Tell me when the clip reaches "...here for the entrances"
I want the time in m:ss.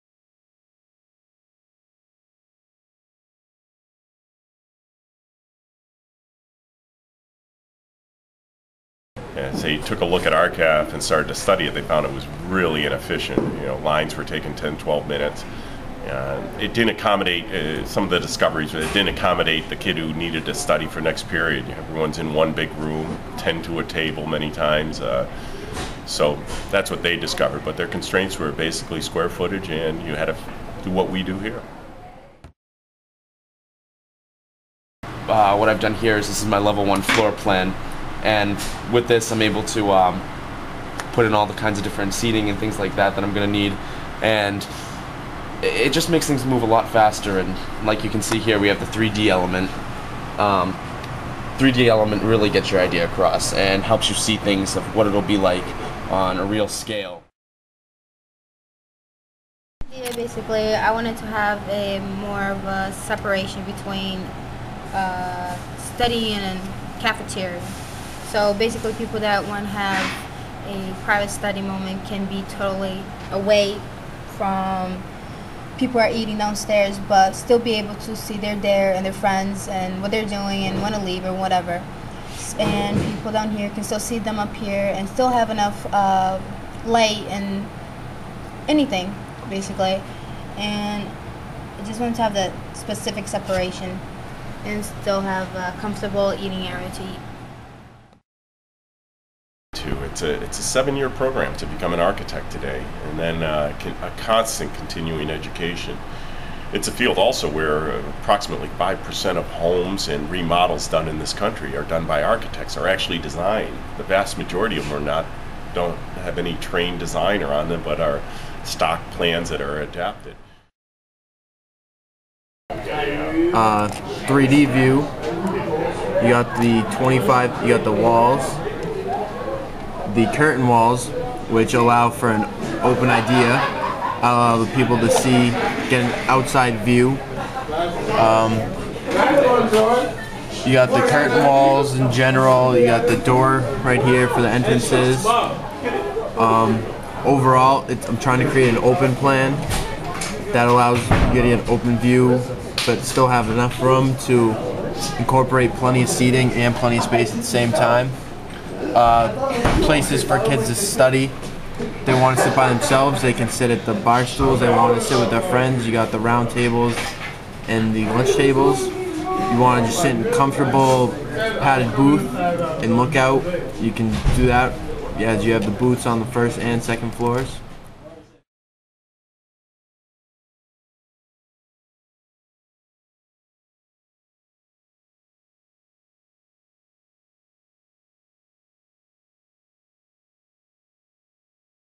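2:24.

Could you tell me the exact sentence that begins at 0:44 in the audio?
And it just makes things move a lot faster.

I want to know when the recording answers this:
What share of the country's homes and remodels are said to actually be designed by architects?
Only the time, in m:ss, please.
1:48.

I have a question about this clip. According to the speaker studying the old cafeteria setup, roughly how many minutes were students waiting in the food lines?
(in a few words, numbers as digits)
10 to 12 minutes.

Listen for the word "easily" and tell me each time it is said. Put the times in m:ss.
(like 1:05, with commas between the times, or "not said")
not said.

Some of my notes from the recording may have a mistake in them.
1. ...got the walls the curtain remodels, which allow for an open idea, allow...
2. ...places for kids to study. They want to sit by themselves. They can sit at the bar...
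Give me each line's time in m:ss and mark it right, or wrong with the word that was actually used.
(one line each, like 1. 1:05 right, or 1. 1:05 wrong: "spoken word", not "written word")
1. 2:07 wrong: "walls", not "remodels"
2. 2:39 right.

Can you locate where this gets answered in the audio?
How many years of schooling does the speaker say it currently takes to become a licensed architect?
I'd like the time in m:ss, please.
1:40.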